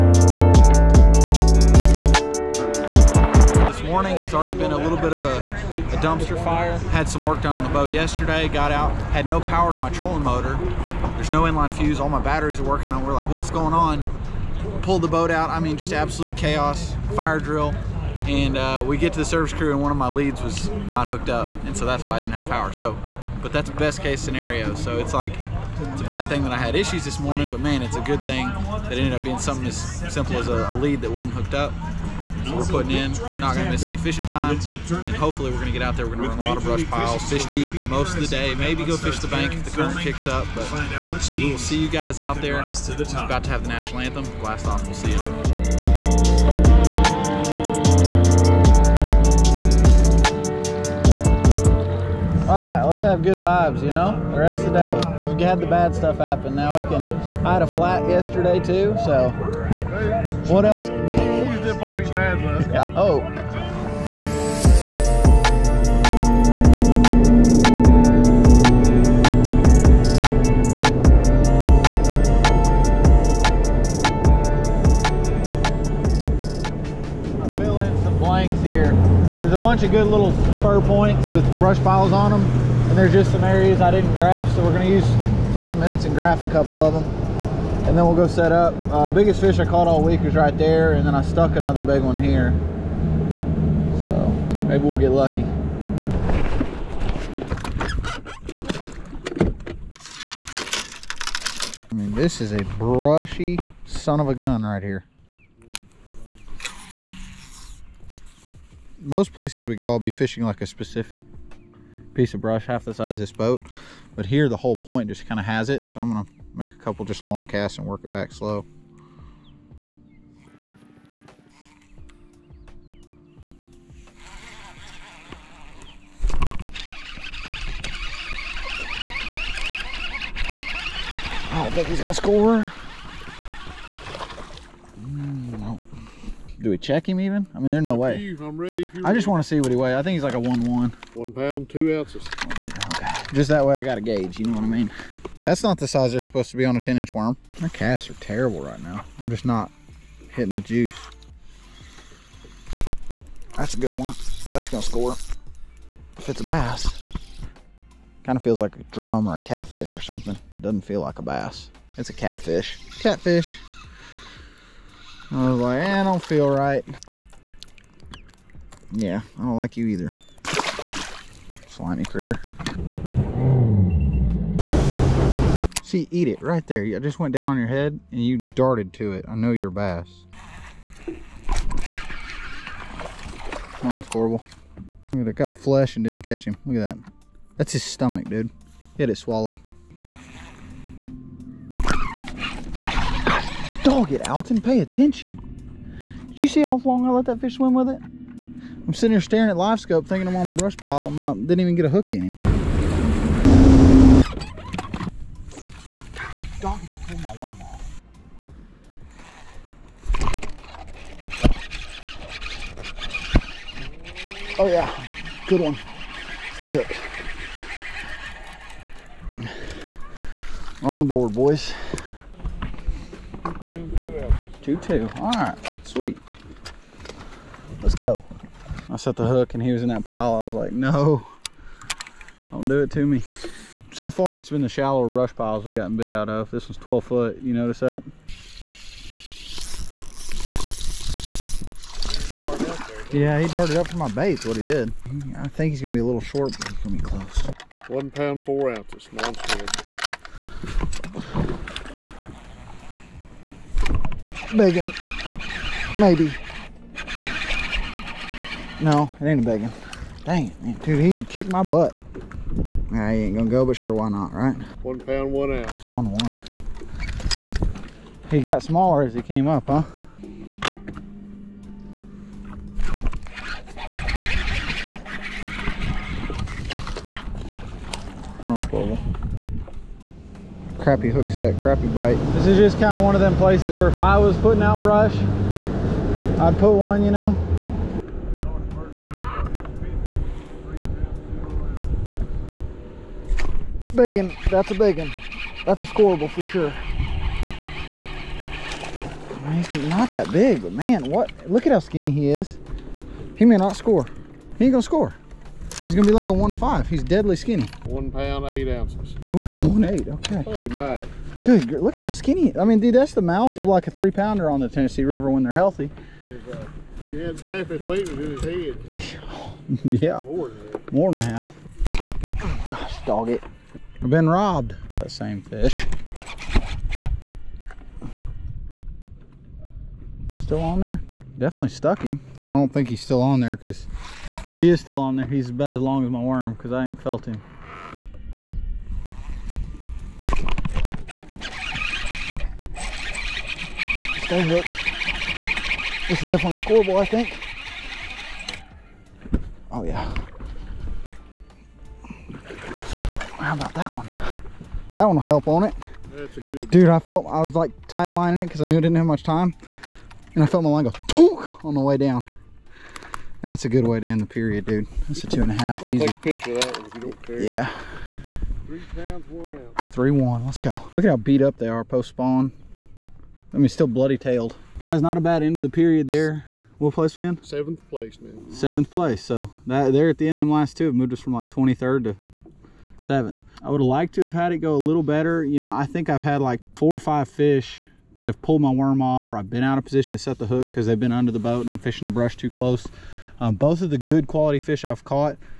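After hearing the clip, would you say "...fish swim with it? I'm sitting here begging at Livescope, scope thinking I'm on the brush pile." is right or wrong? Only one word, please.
wrong.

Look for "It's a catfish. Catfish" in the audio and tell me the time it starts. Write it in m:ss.
2:41.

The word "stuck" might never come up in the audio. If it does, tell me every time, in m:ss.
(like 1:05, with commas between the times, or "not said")
1:31, 5:31.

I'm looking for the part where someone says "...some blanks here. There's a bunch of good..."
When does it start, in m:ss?
1:18.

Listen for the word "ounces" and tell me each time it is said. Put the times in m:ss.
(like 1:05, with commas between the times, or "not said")
2:21, 4:08, 4:25, 5:08.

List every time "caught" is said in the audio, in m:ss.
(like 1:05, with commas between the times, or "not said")
1:29, 6:35.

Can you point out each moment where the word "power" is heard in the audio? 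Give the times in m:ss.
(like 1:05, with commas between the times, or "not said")
0:09, 0:22.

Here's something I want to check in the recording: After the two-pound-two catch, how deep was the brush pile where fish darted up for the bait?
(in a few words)
12 foot.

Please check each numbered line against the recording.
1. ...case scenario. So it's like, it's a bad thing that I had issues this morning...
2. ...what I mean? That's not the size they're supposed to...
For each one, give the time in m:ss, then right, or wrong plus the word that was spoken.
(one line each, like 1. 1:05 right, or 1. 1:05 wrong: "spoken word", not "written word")
1. 0:24 right
2. 2:24 right.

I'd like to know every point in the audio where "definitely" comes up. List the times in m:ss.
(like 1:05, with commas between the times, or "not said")
5:31, 5:46.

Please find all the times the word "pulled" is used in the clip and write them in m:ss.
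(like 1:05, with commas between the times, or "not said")
0:14, 3:27, 6:28.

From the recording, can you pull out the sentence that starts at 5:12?
I mean, dude, that's the mouth yeah.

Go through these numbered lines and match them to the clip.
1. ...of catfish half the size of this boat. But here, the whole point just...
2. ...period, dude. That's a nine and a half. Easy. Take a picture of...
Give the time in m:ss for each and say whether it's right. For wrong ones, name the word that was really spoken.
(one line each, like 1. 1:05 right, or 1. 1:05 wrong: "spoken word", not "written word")
1. 1:52 wrong: "brush", not "catfish"
2. 6:04 wrong: "two", not "nine".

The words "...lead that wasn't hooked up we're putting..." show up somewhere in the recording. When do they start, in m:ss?
0:30.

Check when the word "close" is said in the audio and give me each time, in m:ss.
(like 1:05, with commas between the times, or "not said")
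4:07, 6:32.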